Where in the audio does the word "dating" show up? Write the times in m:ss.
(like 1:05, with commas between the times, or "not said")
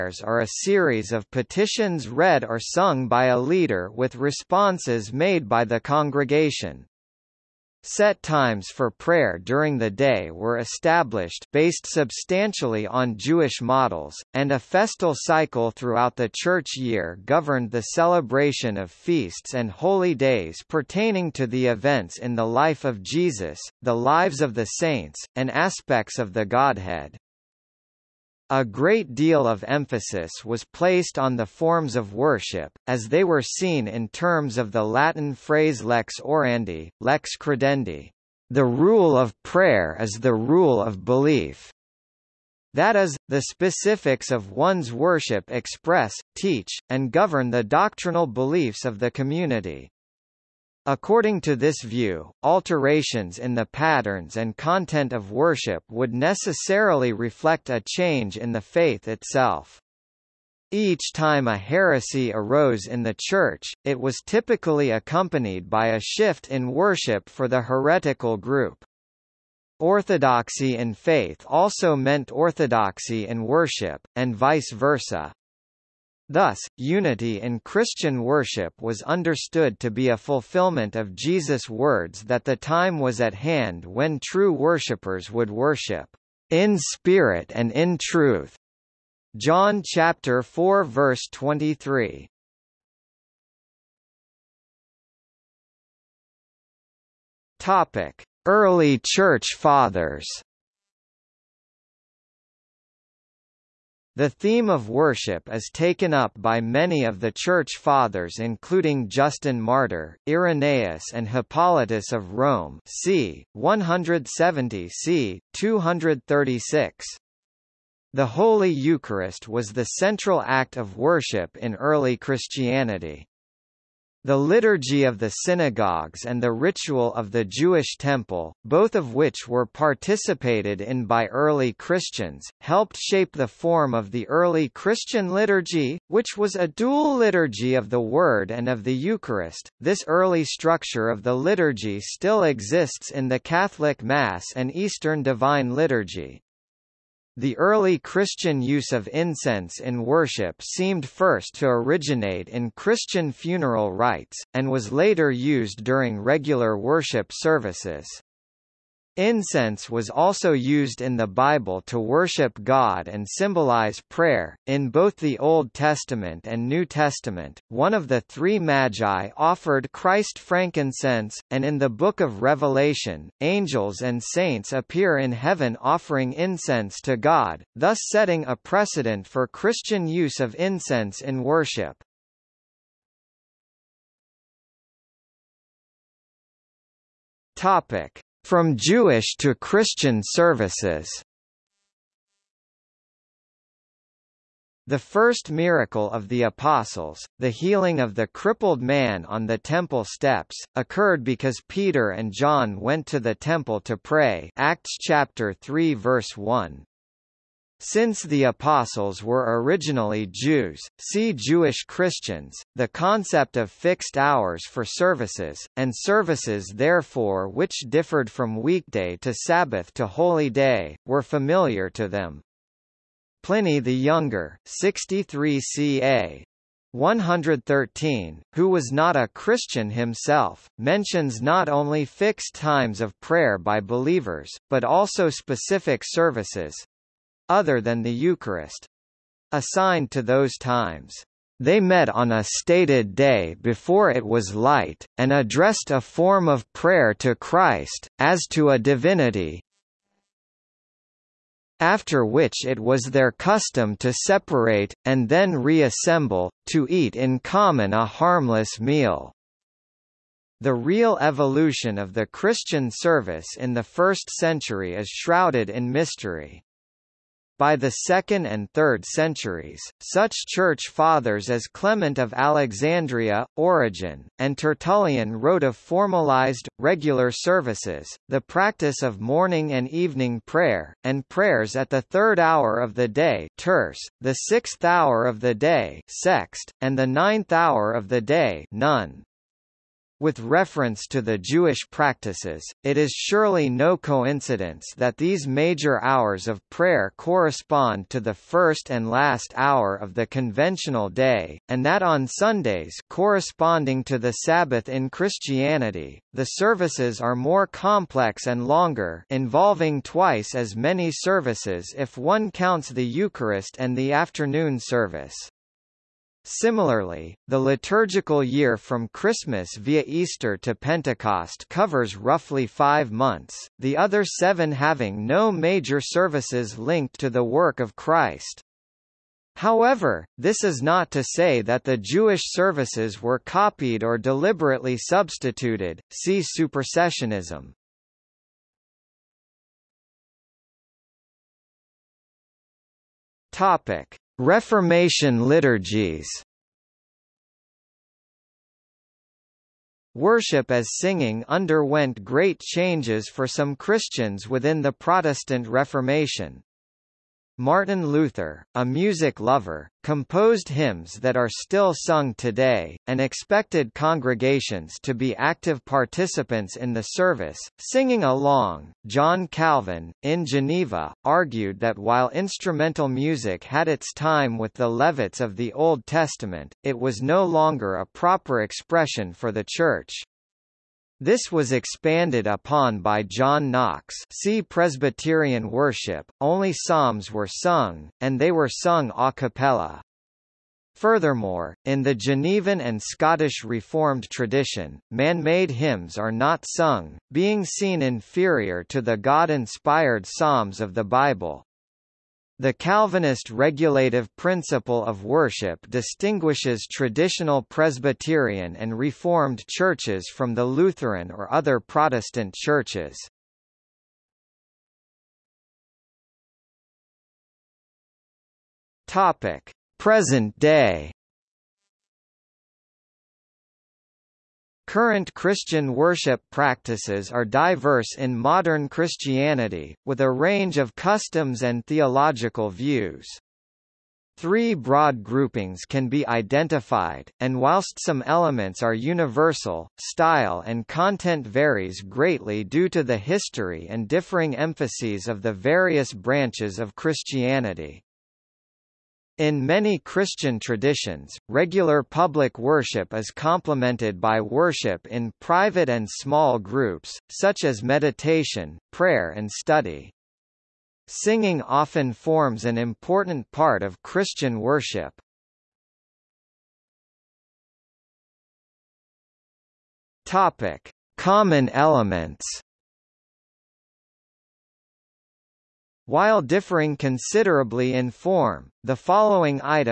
not said.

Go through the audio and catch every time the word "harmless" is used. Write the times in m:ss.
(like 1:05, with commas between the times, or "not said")
4:18.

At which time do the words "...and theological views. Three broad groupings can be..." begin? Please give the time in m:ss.
7:11.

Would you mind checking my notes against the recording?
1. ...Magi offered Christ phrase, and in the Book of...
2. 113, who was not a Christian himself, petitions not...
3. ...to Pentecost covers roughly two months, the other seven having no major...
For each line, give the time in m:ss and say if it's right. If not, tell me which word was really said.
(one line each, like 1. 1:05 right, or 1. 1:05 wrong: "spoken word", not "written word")
1. 2:48 wrong: "frankincense", not "phrase"
2. 3:46 wrong: "mentions", not "petitions"
3. 5:20 wrong: "five", not "two".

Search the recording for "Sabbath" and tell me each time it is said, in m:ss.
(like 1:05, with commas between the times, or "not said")
3:39, 5:04.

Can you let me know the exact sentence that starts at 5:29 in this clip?
However, this is not to say that the Jewish services were copied or deliberately substituted, see supersessionism.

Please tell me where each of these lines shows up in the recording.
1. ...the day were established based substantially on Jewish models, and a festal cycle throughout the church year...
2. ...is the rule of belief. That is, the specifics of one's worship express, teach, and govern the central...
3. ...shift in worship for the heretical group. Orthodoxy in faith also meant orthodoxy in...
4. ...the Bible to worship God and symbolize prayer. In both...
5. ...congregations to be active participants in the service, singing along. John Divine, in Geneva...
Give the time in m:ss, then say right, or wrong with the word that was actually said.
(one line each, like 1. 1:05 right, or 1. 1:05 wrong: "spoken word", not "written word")
1. 0:09 right
2. 0:39 wrong: "doctrinal", not "central"
3. 1:05 right
4. 2:41 right
5. 6:03 wrong: "Calvin", not "Divine".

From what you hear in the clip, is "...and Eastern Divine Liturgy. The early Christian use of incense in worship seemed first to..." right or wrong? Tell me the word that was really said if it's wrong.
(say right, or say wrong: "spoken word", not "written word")
right.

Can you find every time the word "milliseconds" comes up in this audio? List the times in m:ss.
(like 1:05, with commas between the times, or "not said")
not said.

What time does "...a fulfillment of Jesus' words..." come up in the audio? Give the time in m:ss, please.
1:20.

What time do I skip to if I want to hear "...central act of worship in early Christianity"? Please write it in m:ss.
1:59.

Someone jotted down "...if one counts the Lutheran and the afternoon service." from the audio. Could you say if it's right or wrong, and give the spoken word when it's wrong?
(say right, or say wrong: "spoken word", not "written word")
wrong: "Eucharist", not "Lutheran".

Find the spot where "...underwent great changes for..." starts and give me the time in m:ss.
5:51.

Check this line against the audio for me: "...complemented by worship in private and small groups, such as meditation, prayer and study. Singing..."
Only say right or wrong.
right.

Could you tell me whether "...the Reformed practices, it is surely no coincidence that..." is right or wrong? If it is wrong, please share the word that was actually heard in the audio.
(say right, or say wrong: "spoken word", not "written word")
wrong: "Jewish", not "Reformed".